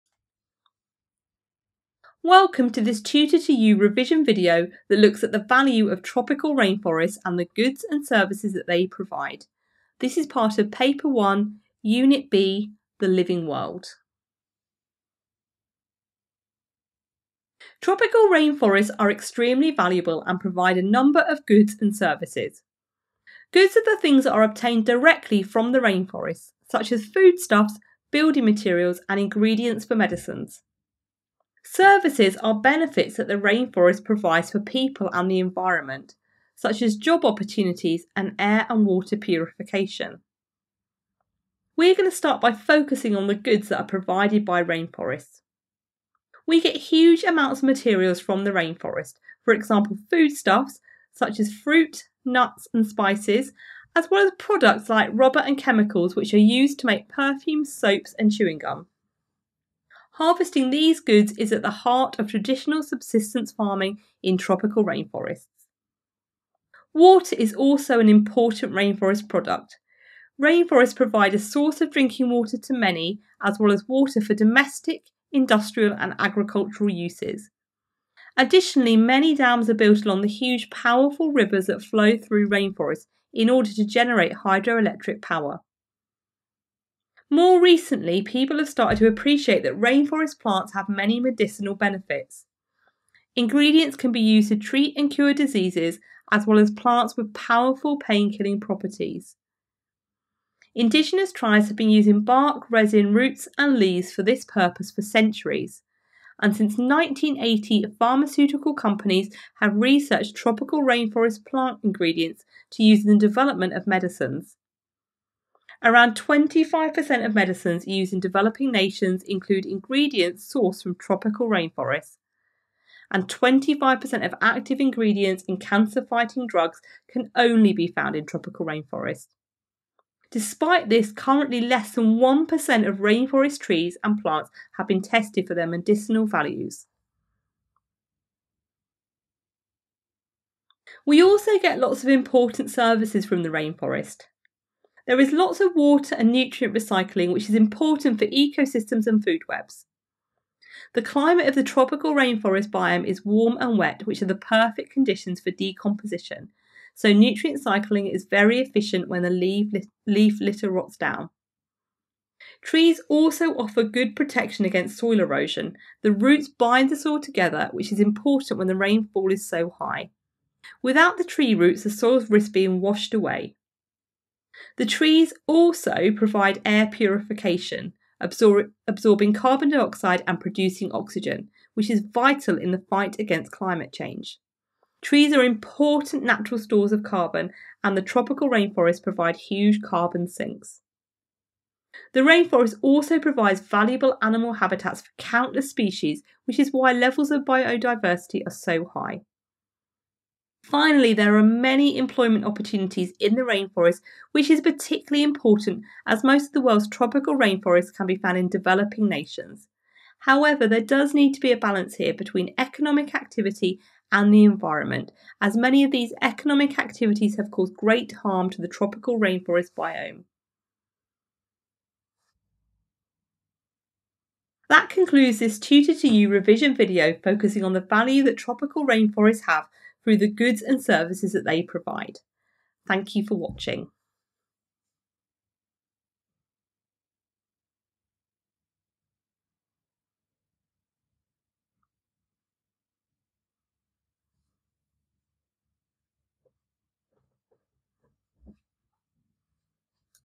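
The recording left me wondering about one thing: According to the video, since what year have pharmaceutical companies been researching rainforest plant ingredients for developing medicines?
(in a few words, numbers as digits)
1980.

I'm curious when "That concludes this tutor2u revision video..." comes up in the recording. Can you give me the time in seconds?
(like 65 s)
224 s.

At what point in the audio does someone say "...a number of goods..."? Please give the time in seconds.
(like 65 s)
20 s.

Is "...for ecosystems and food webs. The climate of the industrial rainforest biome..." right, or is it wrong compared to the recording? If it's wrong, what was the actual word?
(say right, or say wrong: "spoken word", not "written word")
wrong: "tropical", not "industrial".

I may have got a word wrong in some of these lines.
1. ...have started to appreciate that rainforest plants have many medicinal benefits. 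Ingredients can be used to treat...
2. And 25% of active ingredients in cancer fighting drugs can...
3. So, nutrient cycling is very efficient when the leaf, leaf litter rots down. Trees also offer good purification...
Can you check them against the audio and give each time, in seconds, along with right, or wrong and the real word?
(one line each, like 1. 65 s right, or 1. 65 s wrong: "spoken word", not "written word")
1. 88 s right
2. 123 s right
3. 156 s wrong: "protection", not "purification".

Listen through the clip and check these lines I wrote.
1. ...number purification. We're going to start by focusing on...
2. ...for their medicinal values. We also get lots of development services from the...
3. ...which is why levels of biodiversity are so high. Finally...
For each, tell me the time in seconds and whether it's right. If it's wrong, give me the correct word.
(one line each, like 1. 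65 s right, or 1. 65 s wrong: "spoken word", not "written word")
1. 38 s wrong: "water", not "number"
2. 135 s wrong: "important", not "development"
3. 196 s right.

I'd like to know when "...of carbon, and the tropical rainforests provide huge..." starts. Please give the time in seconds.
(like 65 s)
186 s.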